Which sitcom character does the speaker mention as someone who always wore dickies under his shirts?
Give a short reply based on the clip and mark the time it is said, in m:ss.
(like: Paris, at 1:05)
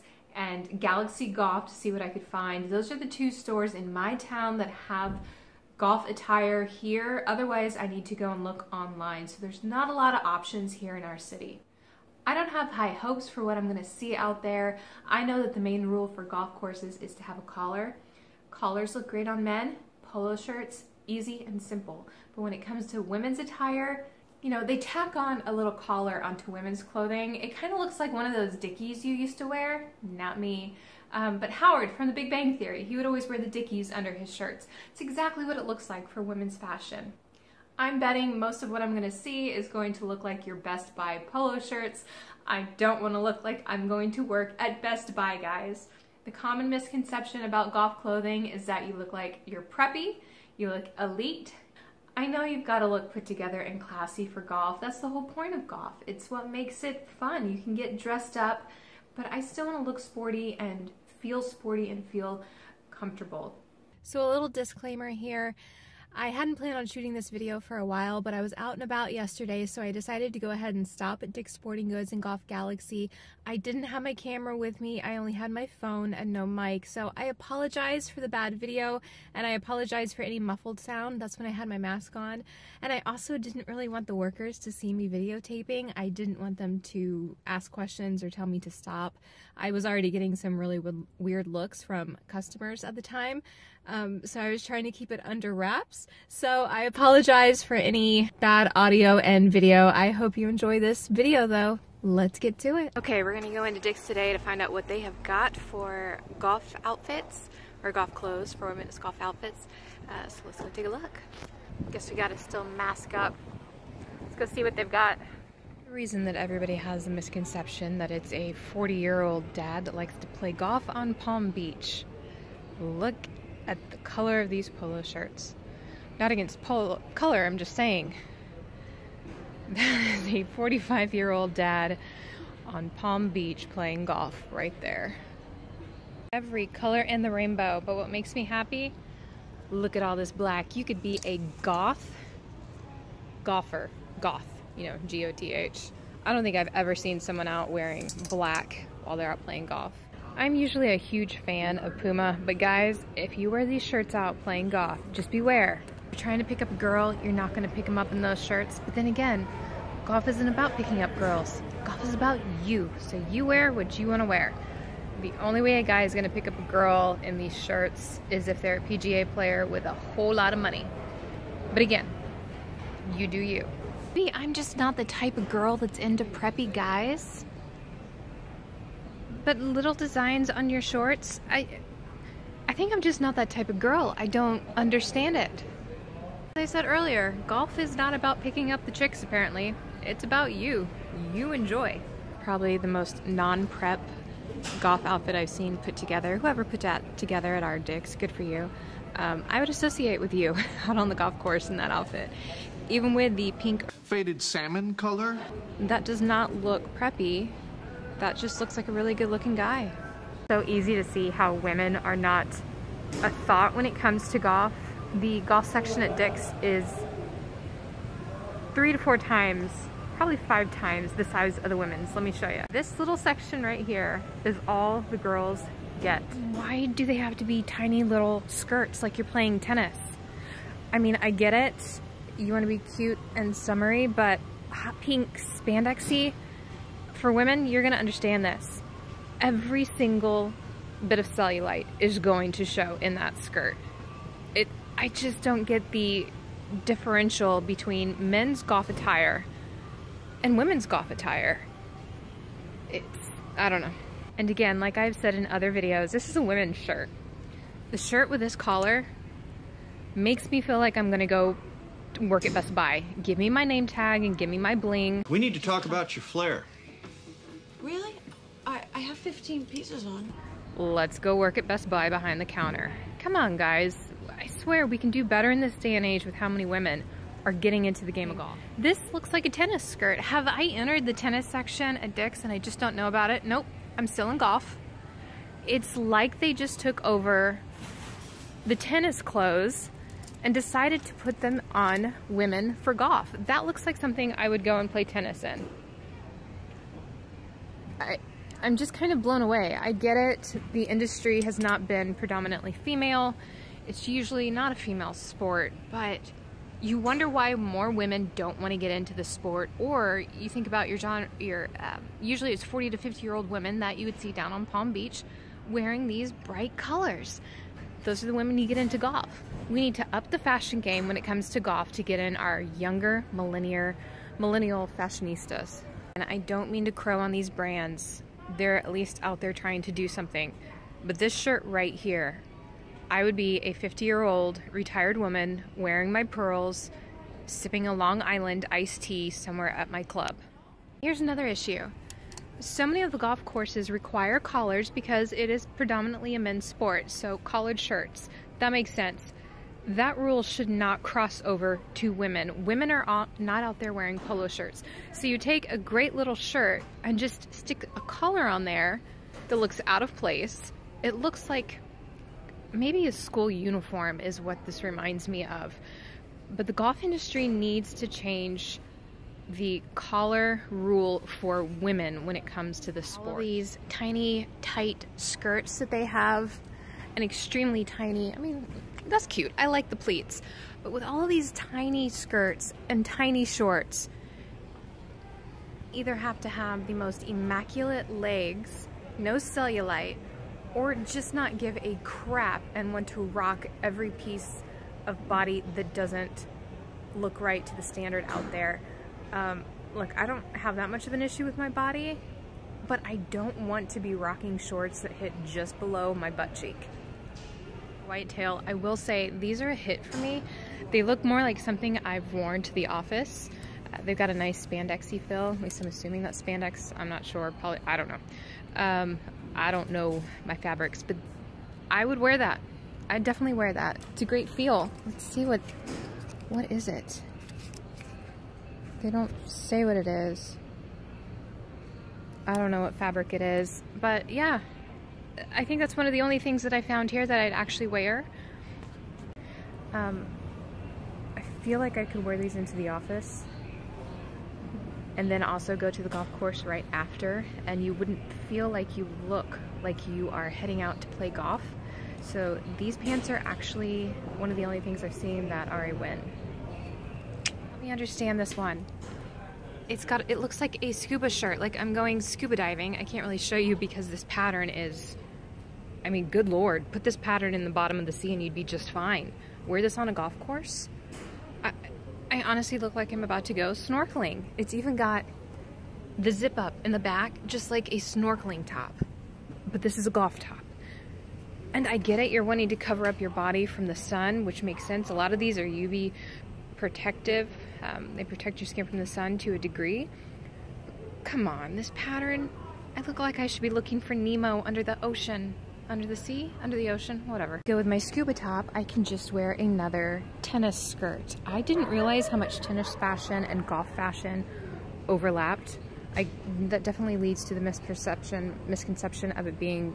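Howard, at 0:31.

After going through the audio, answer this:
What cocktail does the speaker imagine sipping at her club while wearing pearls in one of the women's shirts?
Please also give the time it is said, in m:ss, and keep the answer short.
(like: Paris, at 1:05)
Long Island iced tea, at 5:37.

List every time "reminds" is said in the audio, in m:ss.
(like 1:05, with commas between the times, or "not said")
6:04.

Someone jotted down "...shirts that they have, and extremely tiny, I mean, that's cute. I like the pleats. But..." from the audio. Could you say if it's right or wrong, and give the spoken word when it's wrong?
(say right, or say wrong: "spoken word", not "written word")
wrong: "skirts", not "shirts".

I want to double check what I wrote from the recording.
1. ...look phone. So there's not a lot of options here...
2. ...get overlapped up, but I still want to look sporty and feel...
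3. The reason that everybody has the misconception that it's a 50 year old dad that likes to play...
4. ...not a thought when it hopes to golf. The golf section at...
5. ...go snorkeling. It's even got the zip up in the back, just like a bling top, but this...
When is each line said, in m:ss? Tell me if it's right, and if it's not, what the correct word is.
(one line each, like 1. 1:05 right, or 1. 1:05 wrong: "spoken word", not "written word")
1. 0:08 wrong: "online", not "phone"
2. 0:57 wrong: "dressed", not "overlapped"
3. 1:55 wrong: "40", not "50"
4. 3:32 wrong: "comes", not "hopes"
5. 7:53 wrong: "snorkeling", not "bling".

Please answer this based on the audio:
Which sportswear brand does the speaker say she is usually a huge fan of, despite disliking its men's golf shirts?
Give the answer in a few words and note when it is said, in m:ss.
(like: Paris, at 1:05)
Puma, at 2:31.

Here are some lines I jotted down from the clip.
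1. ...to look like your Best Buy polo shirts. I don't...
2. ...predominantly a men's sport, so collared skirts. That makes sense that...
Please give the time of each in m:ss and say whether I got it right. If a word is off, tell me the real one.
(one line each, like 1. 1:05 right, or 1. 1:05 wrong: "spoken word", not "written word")
1. 0:39 right
2. 5:45 wrong: "shirts", not "skirts".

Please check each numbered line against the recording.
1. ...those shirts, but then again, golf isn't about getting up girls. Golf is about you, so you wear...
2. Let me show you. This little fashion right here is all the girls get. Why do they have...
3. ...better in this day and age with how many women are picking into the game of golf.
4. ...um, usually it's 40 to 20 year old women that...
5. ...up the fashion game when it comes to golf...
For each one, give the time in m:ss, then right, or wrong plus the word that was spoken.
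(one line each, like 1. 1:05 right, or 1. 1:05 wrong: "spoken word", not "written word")
1. 2:38 wrong: "picking", not "getting"
2. 3:42 wrong: "section", not "fashion"
3. 4:35 wrong: "getting", not "picking"
4. 5:11 wrong: "50", not "20"
5. 5:20 right.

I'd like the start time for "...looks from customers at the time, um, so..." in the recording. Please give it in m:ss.
1:31.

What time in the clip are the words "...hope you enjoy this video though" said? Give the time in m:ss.
1:40.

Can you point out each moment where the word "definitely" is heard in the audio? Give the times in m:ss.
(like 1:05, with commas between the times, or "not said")
7:03, 8:26.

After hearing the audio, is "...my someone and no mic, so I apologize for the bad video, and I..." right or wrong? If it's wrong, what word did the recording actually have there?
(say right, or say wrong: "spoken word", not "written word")
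wrong: "phone", not "someone".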